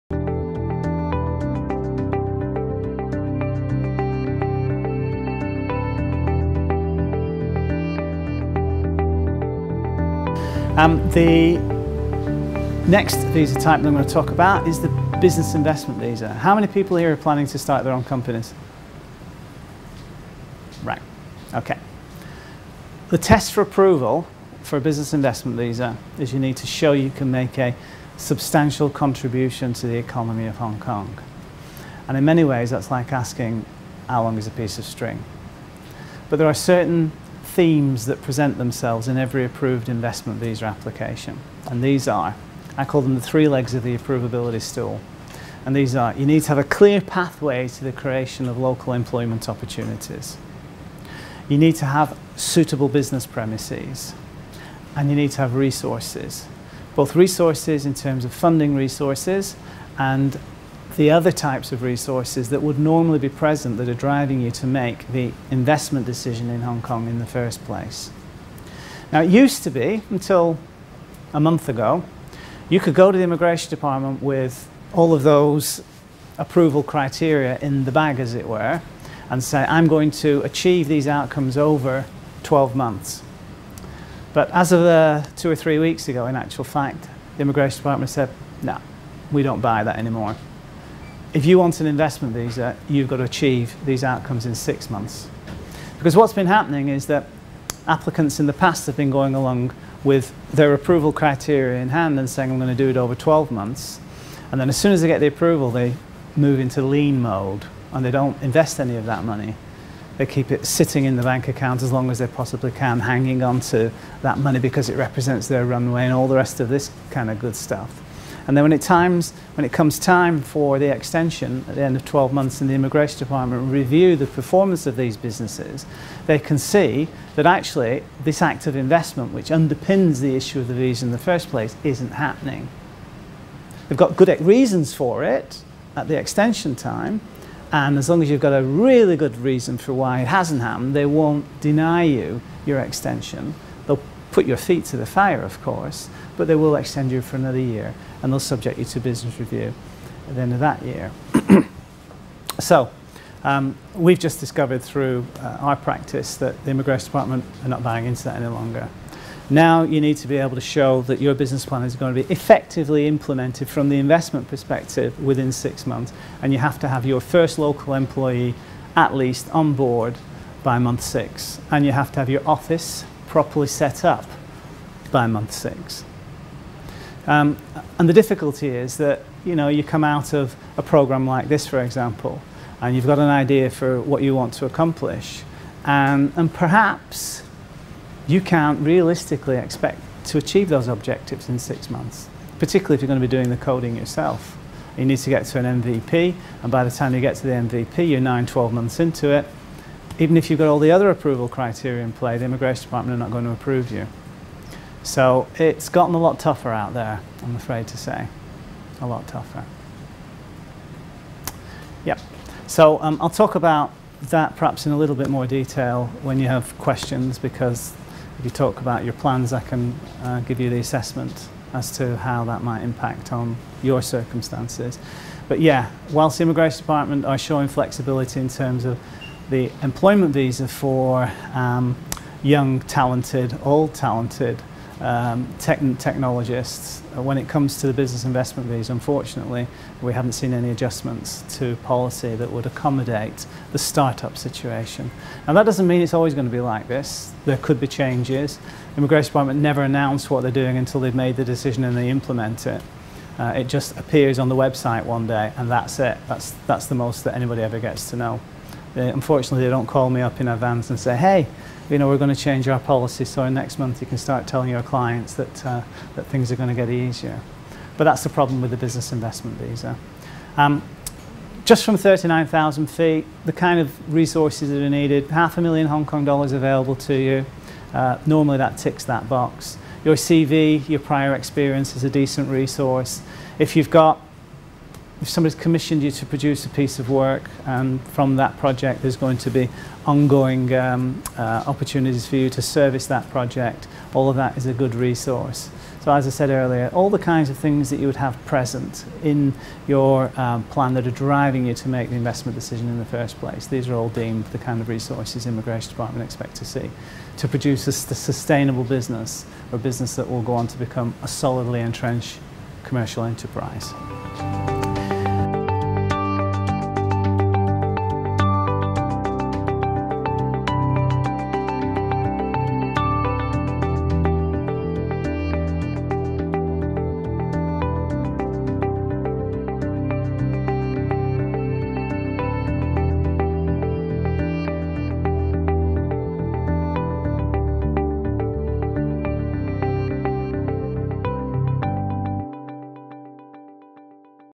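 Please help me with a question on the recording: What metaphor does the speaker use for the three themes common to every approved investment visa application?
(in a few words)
three legs of the approvability stool.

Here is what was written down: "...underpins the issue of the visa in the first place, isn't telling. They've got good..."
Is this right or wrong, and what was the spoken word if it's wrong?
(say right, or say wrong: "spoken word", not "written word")
wrong: "happening", not "telling".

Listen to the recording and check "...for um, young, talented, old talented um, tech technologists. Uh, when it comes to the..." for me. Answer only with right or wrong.
right.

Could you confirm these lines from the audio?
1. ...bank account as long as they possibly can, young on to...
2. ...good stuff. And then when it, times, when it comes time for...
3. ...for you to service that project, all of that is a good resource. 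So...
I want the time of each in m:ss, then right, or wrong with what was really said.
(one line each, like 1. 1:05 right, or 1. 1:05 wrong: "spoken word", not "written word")
1. 1:51 wrong: "hanging", not "young"
2. 1:57 right
3. 4:52 right.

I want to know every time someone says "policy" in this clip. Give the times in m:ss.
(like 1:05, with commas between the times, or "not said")
4:01, 4:22.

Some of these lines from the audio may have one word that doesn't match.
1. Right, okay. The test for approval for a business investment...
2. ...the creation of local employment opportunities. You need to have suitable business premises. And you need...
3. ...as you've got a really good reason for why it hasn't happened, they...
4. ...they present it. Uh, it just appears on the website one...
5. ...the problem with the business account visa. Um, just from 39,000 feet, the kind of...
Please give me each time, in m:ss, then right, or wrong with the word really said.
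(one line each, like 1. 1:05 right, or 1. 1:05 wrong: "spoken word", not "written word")
1. 0:20 right
2. 0:47 right
3. 2:18 right
4. 4:11 wrong: "implement", not "present"
5. 4:28 wrong: "investment", not "account".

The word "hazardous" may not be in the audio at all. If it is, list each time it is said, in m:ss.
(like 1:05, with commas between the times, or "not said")
not said.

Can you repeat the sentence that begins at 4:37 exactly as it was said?
Uh, normally that ticks that box.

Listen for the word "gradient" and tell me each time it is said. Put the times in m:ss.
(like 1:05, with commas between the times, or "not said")
not said.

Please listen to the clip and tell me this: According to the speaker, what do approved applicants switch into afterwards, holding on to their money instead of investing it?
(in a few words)
lean mode.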